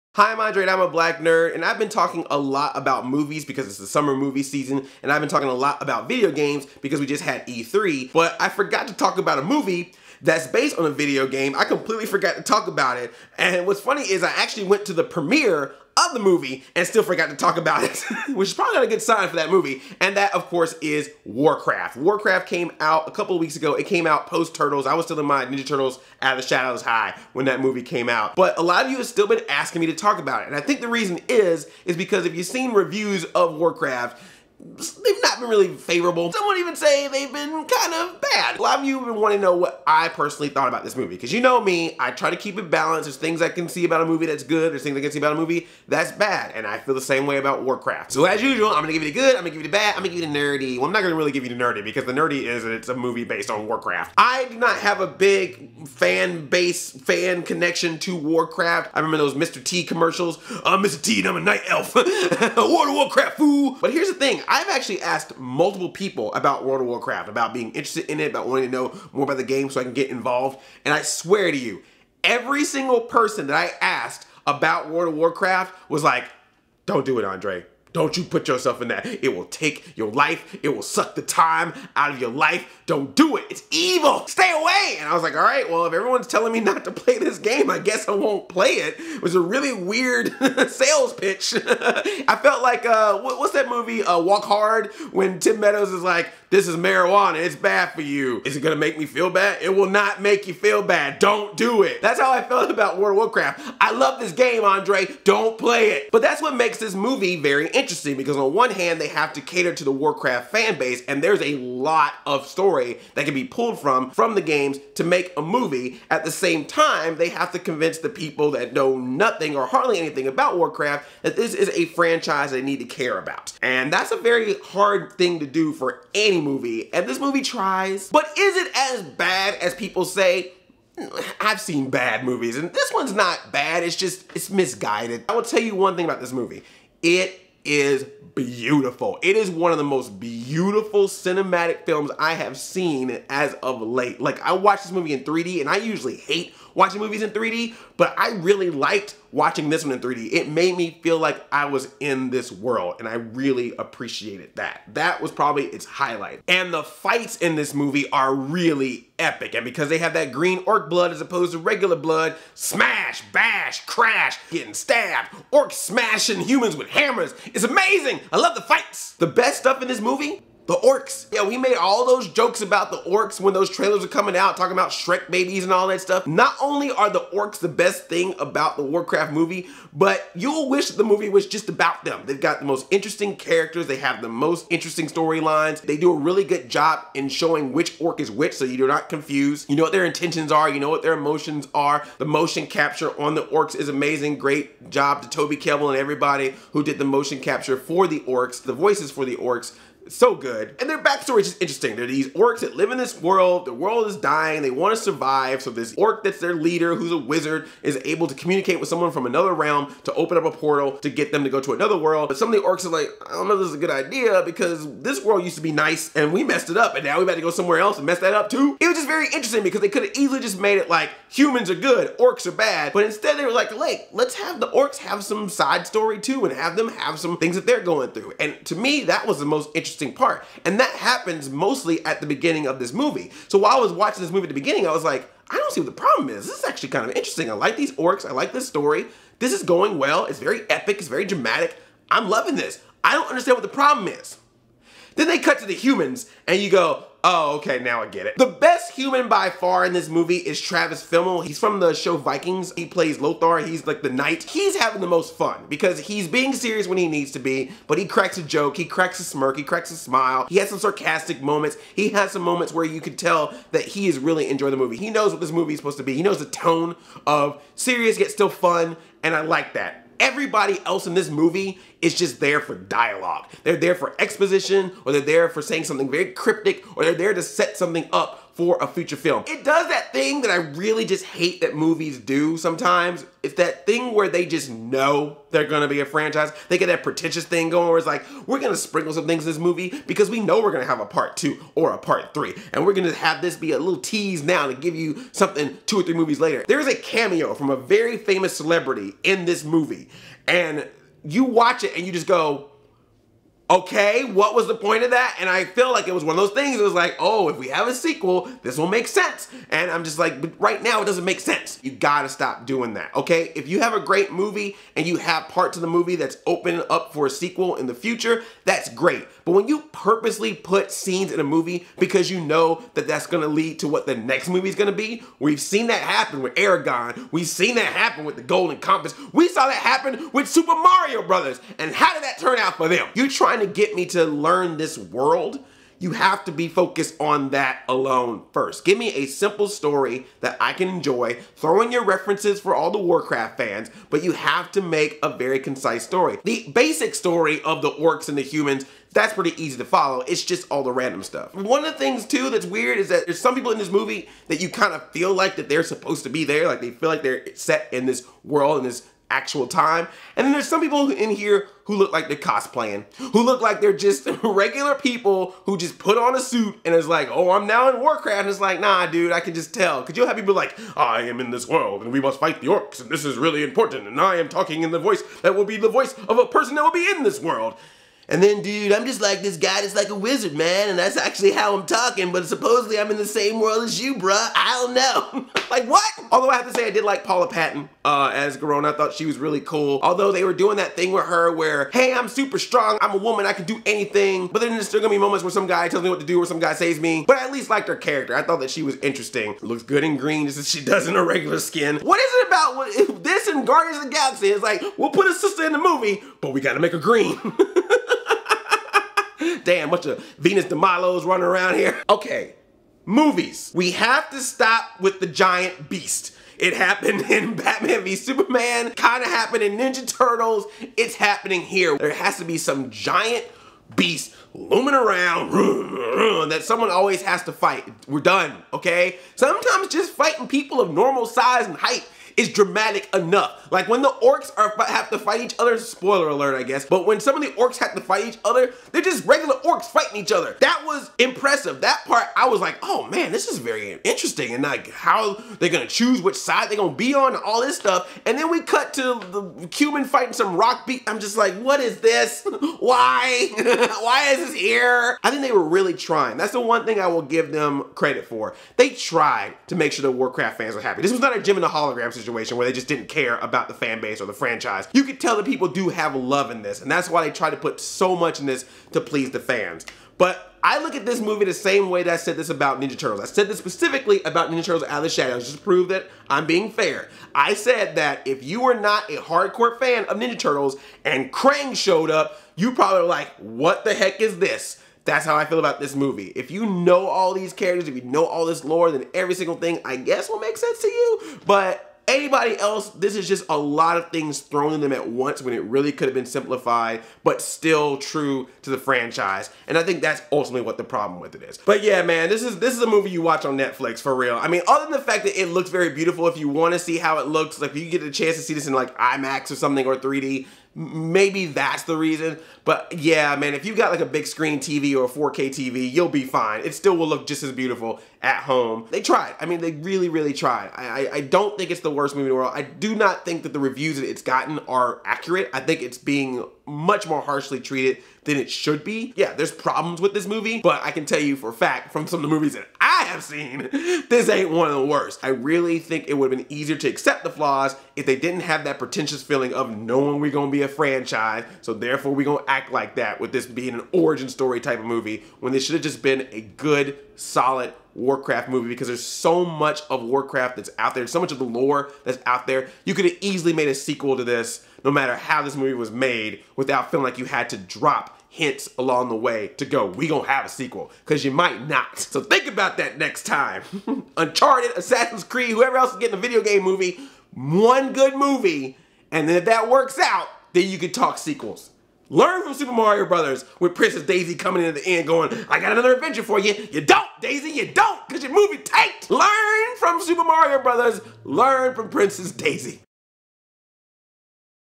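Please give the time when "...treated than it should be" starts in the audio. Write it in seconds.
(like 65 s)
527 s.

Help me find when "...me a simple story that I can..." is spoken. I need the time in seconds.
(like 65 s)
338 s.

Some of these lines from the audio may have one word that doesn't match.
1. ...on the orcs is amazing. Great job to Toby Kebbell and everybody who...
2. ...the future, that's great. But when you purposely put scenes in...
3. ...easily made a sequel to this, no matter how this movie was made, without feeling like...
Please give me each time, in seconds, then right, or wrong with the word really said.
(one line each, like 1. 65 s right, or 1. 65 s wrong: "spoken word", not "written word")
1. 193 s right
2. 317 s right
3. 553 s right.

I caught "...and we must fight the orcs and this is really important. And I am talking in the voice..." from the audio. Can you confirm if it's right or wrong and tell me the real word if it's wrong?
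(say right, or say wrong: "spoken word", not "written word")
right.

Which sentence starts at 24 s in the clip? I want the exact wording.
I was still in my Ninja Turtles Out of the Shadows High when that movie came out.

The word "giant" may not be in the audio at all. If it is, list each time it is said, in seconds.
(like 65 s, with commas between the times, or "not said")
415 s, 422 s.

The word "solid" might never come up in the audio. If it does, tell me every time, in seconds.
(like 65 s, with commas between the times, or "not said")
547 s.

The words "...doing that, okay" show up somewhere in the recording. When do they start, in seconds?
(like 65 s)
312 s.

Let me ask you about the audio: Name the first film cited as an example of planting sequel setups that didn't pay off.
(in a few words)
Eragon.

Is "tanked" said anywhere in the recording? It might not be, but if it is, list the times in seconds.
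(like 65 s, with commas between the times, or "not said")
578 s.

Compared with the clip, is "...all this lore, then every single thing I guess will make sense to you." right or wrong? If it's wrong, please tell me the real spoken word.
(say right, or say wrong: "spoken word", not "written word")
right.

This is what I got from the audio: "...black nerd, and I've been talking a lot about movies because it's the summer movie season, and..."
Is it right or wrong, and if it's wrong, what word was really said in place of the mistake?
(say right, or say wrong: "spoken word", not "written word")
right.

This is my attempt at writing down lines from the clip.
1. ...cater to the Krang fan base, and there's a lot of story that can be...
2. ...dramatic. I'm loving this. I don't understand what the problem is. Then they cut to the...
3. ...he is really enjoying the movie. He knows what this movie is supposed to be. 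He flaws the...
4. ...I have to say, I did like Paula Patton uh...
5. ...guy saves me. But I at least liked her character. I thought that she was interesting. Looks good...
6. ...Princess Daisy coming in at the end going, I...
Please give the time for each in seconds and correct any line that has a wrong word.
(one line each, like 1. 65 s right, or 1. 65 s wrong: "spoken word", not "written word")
1. 109 s wrong: "Warcraft", not "Krang"
2. 241 s right
3. 263 s wrong: "knows", not "flaws"
4. 386 s right
5. 396 s right
6. 573 s right.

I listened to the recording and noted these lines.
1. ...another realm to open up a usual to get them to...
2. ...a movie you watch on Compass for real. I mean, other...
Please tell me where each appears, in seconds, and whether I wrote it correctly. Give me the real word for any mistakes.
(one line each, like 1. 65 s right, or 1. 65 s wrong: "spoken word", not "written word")
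1. 209 s wrong: "portal", not "usual"
2. 502 s wrong: "Netflix", not "Compass".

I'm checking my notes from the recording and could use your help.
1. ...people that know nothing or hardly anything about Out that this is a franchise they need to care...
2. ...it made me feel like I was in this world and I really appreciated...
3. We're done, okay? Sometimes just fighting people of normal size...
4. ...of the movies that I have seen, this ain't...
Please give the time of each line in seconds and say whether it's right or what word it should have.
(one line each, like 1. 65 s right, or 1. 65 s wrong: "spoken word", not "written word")
1. 118 s wrong: "Warcraft", not "Out"
2. 150 s right
3. 428 s right
4. 532 s right.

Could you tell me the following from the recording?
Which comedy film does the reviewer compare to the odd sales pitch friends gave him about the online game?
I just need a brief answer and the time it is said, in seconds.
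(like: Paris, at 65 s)
Walk Hard, at 94 s.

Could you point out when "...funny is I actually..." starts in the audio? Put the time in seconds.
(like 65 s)
13 s.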